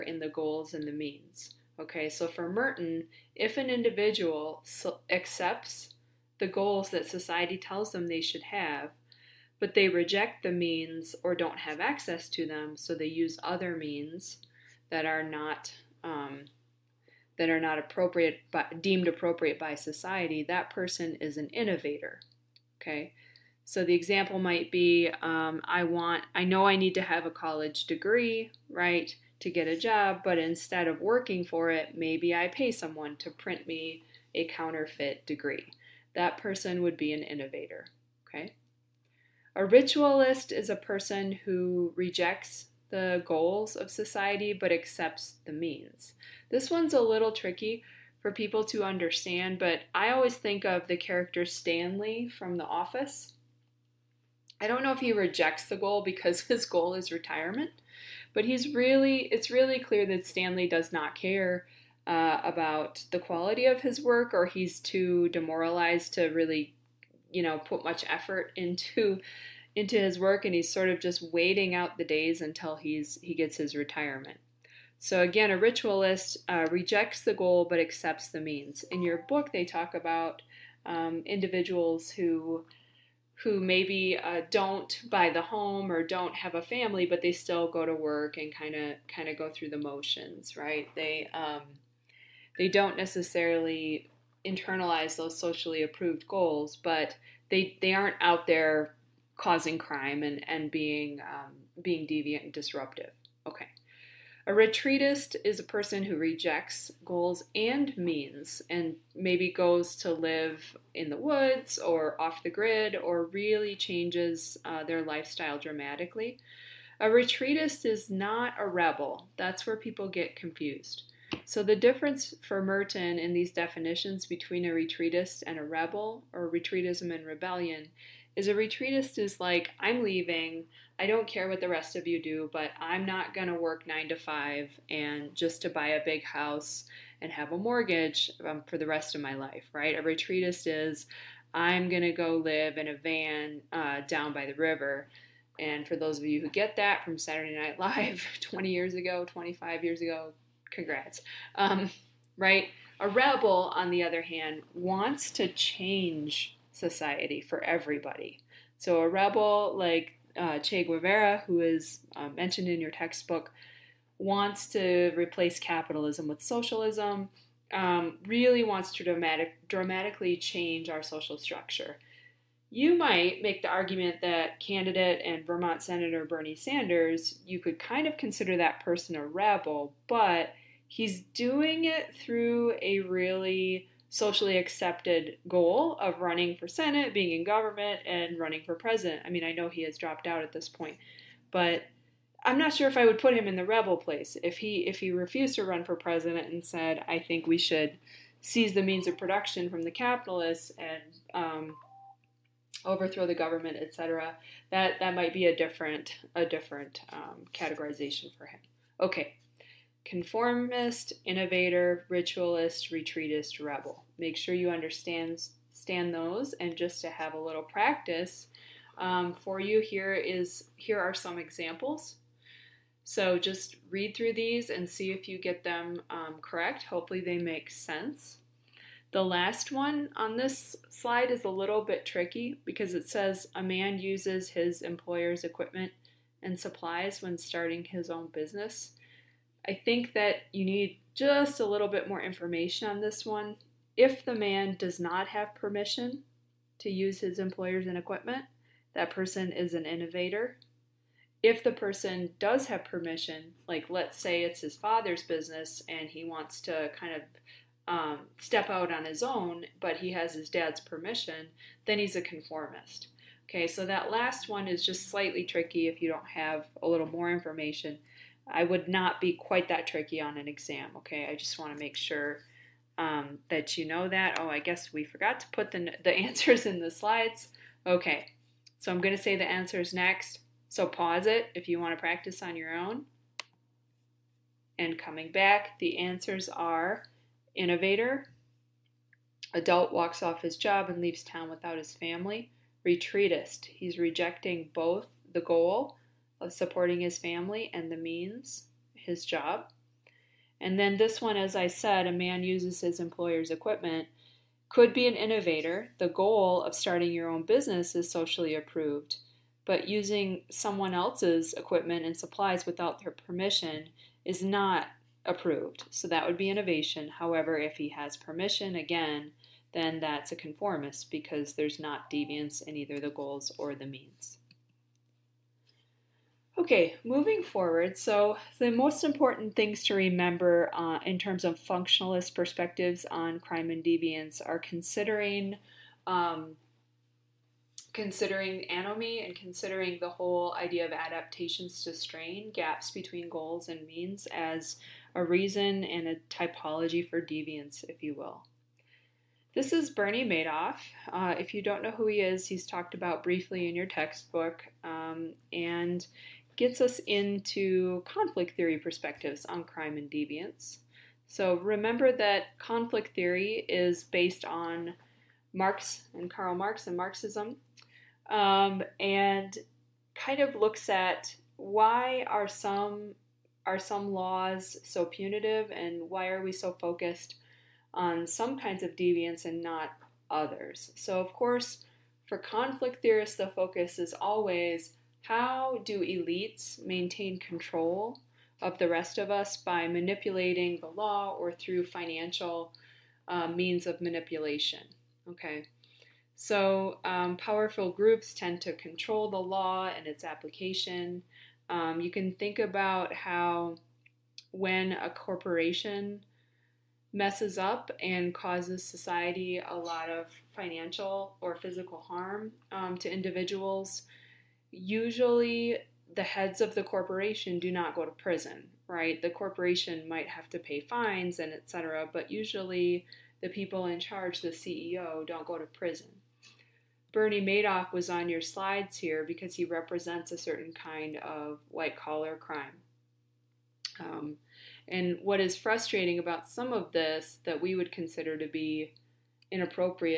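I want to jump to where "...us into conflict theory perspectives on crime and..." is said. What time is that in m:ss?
5:56.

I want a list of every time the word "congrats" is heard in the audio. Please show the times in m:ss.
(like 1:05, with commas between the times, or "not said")
2:30.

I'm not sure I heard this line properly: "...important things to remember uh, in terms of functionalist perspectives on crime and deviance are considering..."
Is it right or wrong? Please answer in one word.
right.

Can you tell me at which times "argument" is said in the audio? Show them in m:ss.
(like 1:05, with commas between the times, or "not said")
2:53.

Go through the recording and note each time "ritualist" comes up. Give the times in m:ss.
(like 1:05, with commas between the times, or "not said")
0:39, 1:15, 3:32.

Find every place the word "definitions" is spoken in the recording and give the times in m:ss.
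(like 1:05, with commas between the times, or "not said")
2:03.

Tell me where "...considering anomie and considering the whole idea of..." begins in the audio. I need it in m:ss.
5:37.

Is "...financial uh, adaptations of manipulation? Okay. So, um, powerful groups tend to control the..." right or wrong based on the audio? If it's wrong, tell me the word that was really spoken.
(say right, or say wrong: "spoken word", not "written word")
wrong: "means", not "adaptations".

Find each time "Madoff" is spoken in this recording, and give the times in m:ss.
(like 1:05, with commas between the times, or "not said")
5:50, 7:07.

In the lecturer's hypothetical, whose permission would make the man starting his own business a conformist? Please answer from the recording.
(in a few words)
his dad's.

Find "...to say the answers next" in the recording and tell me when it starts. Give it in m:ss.
4:39.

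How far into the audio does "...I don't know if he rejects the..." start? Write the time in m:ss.
0:54.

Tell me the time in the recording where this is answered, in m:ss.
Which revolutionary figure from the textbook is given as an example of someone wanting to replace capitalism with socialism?
2:40.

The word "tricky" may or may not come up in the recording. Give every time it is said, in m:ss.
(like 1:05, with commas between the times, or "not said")
0:47, 3:52, 4:25, 4:29.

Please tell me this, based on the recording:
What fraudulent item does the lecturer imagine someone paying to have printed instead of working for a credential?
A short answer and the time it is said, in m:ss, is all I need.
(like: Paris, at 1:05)
counterfeit degree, at 0:34.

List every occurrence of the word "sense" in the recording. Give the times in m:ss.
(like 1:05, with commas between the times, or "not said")
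3:47.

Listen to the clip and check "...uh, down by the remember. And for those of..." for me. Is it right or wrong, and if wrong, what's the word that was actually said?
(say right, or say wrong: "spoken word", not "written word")
wrong: "river", not "remember".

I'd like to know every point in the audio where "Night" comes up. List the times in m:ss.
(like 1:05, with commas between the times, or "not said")
2:27.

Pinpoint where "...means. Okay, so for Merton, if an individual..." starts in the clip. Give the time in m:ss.
0:00.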